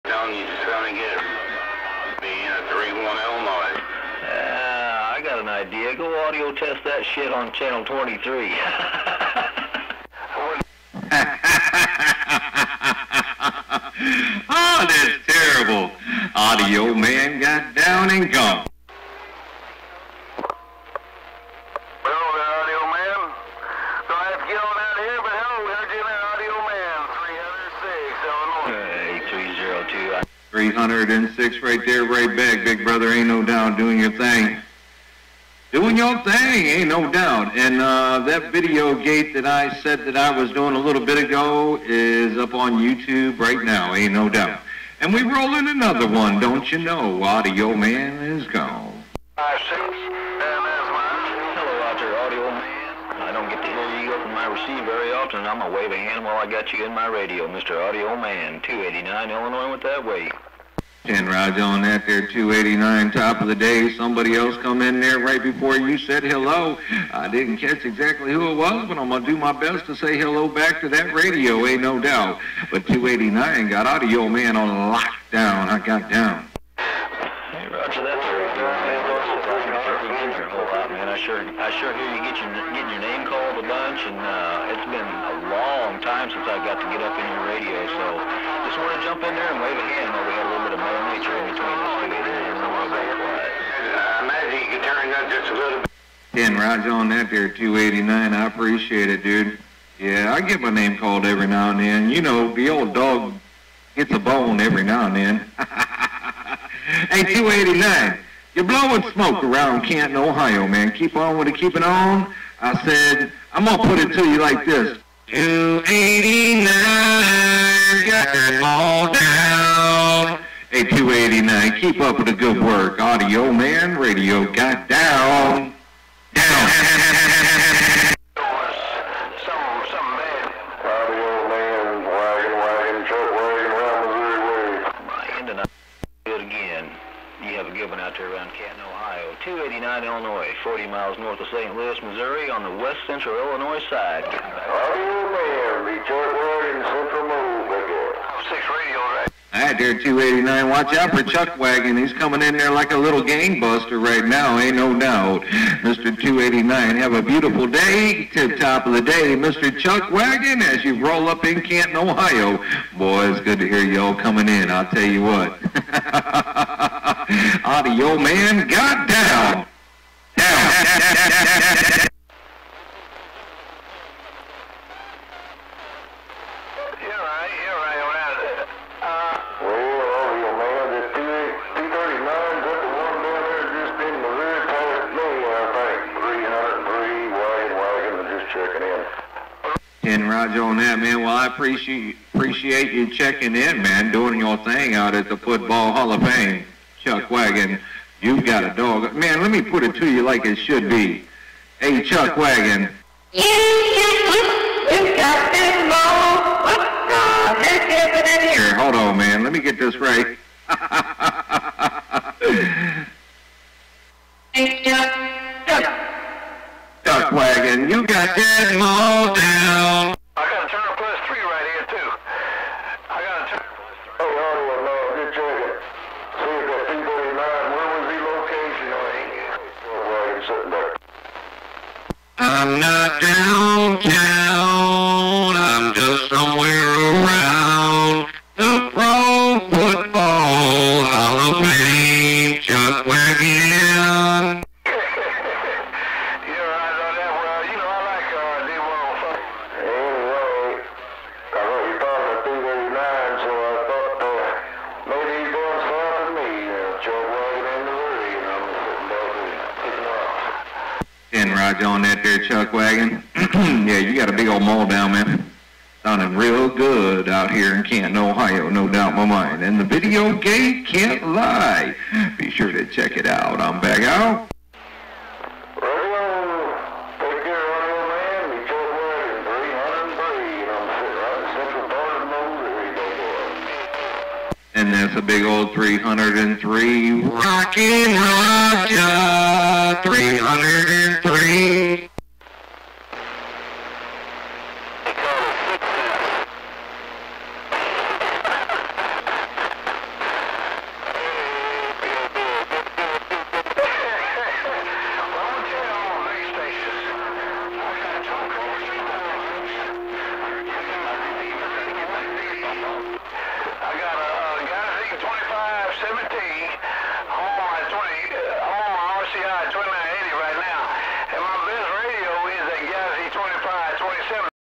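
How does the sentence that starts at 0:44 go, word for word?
And we rolling another one, don't you know?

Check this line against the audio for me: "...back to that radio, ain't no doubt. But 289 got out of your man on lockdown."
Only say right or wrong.
right.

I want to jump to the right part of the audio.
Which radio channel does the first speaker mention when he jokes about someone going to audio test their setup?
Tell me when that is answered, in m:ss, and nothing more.
0:07.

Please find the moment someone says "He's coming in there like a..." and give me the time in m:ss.
2:31.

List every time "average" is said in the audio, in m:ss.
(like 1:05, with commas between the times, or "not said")
not said.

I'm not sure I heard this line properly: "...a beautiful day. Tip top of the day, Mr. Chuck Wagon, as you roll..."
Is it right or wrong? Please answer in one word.
right.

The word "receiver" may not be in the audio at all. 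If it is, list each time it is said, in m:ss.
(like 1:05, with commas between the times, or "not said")
0:54.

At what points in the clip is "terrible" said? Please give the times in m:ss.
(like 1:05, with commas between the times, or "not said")
0:15.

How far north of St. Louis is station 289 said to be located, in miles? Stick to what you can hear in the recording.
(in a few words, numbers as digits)
40.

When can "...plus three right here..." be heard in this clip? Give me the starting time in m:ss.
3:40.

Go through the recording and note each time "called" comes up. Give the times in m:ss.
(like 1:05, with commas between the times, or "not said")
1:23, 1:40.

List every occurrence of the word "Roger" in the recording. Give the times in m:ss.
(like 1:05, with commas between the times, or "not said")
1:01, 1:36, 4:48.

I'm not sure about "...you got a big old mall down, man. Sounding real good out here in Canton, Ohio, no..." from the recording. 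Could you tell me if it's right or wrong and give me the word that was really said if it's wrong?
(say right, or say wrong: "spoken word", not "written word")
right.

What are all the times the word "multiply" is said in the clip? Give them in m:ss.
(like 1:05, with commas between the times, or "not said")
not said.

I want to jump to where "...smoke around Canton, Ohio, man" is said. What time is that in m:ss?
1:49.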